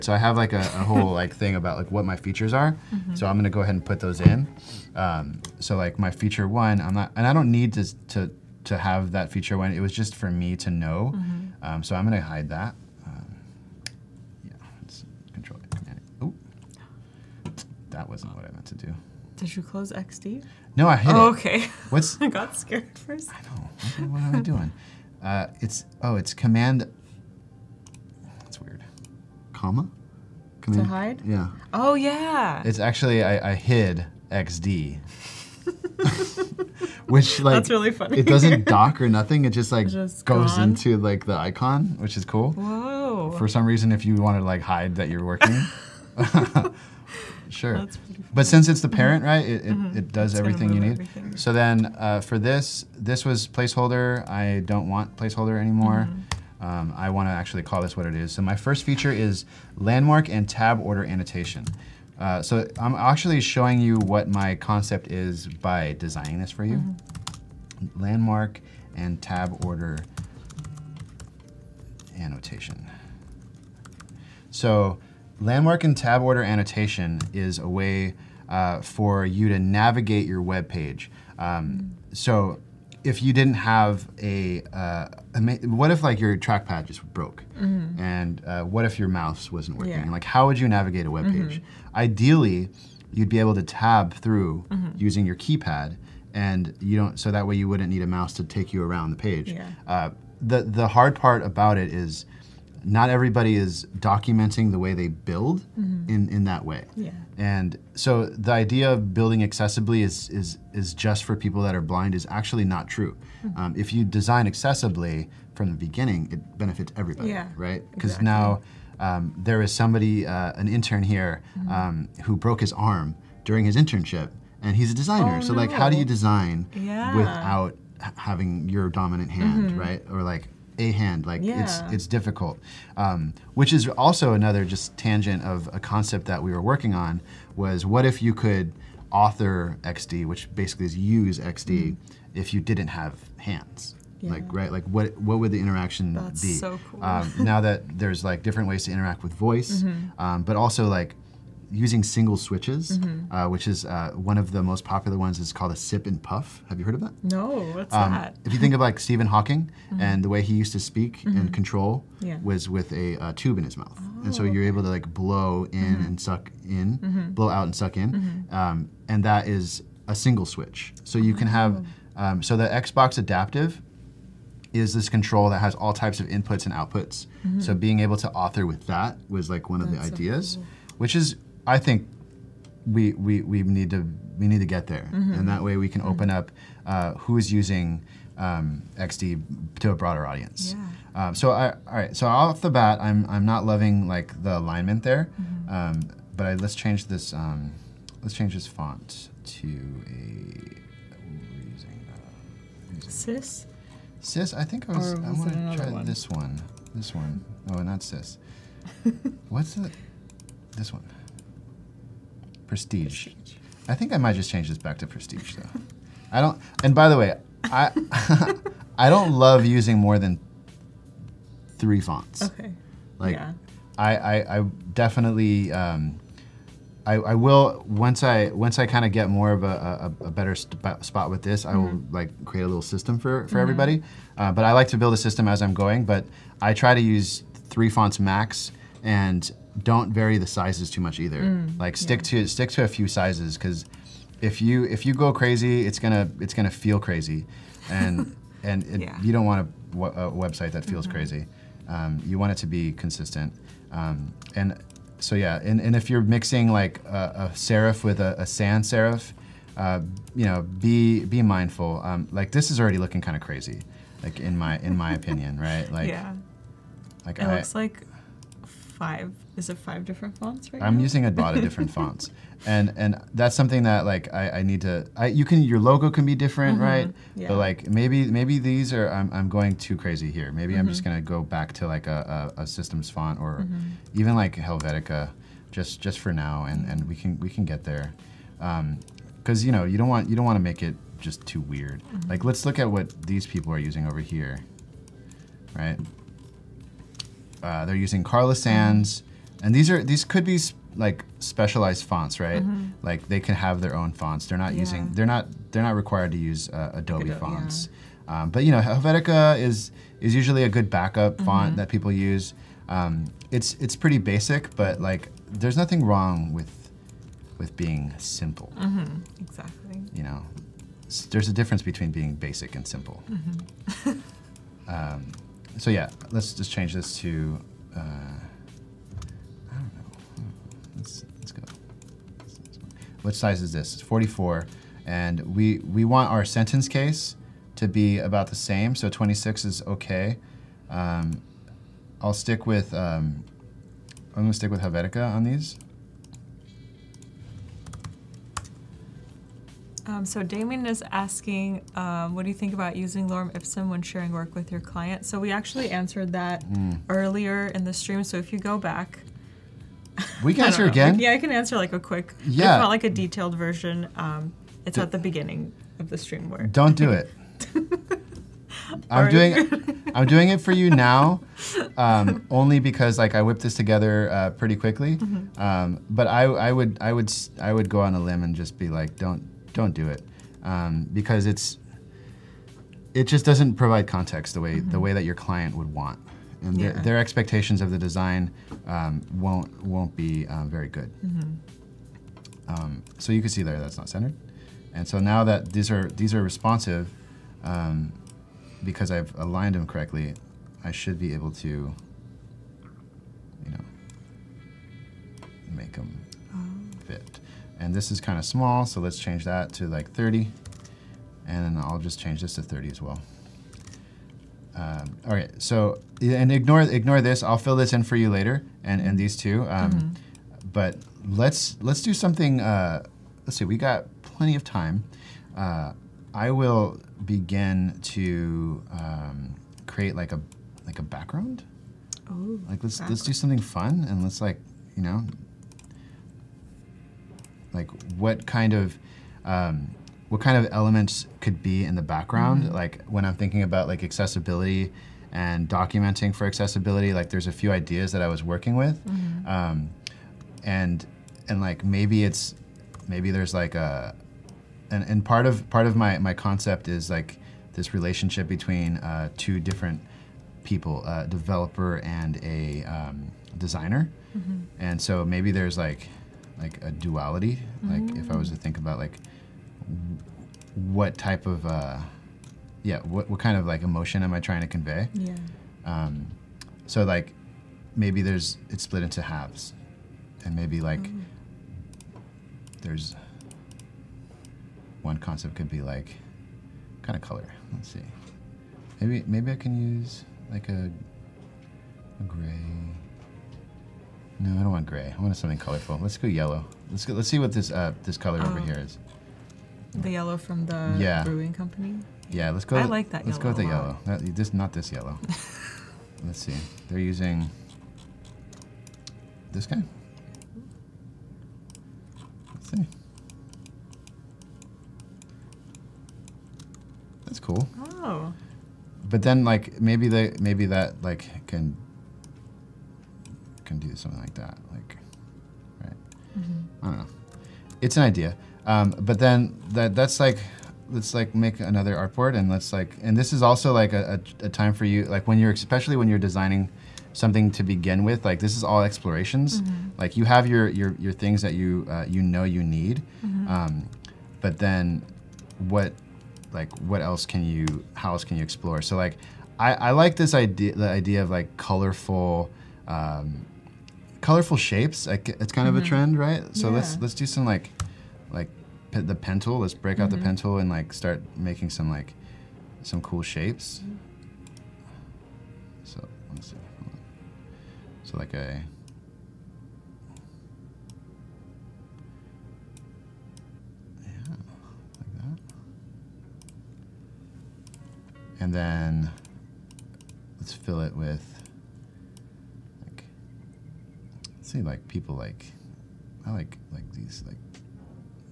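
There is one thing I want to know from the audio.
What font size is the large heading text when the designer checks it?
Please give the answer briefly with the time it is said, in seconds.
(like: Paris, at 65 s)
44, at 333 s.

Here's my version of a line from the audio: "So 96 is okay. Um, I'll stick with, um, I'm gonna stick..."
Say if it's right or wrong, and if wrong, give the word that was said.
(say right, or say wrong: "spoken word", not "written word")
wrong: "26", not "96".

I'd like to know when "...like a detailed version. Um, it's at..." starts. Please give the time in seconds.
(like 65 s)
362 s.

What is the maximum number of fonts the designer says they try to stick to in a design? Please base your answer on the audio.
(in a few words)
3.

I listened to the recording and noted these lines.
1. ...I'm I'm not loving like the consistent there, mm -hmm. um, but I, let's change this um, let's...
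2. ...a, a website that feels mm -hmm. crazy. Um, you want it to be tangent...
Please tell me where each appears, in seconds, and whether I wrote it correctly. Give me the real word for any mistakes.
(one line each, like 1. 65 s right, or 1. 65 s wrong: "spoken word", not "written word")
1. 193 s wrong: "alignment", not "consistent"
2. 249 s wrong: "consistent", not "tangent".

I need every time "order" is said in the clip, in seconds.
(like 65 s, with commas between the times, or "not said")
60 s, 69 s, 76 s.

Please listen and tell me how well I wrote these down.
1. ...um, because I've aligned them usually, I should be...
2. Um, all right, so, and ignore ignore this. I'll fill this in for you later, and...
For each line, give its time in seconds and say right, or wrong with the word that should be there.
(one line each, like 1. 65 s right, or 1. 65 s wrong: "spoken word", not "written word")
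1. 397 s wrong: "correctly", not "usually"
2. 414 s right.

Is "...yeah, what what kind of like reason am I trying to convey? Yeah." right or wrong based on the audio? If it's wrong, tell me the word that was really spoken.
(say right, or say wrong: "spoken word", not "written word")
wrong: "emotion", not "reason".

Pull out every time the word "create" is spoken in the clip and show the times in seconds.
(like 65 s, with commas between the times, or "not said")
232 s, 429 s.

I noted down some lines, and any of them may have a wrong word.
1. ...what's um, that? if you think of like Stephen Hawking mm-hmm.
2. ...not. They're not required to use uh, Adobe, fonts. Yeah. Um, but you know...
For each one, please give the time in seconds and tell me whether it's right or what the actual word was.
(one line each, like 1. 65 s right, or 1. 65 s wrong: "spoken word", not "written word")
1. 157 s right
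2. 305 s right.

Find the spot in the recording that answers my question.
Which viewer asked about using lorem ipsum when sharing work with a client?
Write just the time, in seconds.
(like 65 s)
350 s.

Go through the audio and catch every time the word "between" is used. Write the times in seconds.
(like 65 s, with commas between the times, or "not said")
321 s, 458 s.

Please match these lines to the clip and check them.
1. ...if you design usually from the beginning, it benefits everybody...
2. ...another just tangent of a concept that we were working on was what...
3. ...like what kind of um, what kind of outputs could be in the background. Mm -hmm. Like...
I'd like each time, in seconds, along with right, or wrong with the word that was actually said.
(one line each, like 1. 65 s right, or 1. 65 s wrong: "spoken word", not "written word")
1. 113 s wrong: "accessibly", not "usually"
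2. 134 s right
3. 437 s wrong: "elements", not "outputs".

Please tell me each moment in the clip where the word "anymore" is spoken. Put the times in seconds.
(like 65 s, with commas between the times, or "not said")
55 s.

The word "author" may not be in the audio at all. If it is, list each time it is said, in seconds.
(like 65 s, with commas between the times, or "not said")
139 s, 178 s.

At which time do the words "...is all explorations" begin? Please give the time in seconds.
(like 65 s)
538 s.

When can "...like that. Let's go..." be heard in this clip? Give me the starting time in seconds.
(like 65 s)
502 s.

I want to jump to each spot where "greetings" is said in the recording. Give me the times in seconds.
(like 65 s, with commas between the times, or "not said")
not said.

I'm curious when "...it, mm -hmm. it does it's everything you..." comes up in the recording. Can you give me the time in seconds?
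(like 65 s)
49 s.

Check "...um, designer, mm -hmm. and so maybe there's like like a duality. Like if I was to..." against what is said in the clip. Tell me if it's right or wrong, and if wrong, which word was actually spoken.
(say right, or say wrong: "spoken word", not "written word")
right.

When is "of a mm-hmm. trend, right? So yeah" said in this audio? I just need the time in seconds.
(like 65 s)
555 s.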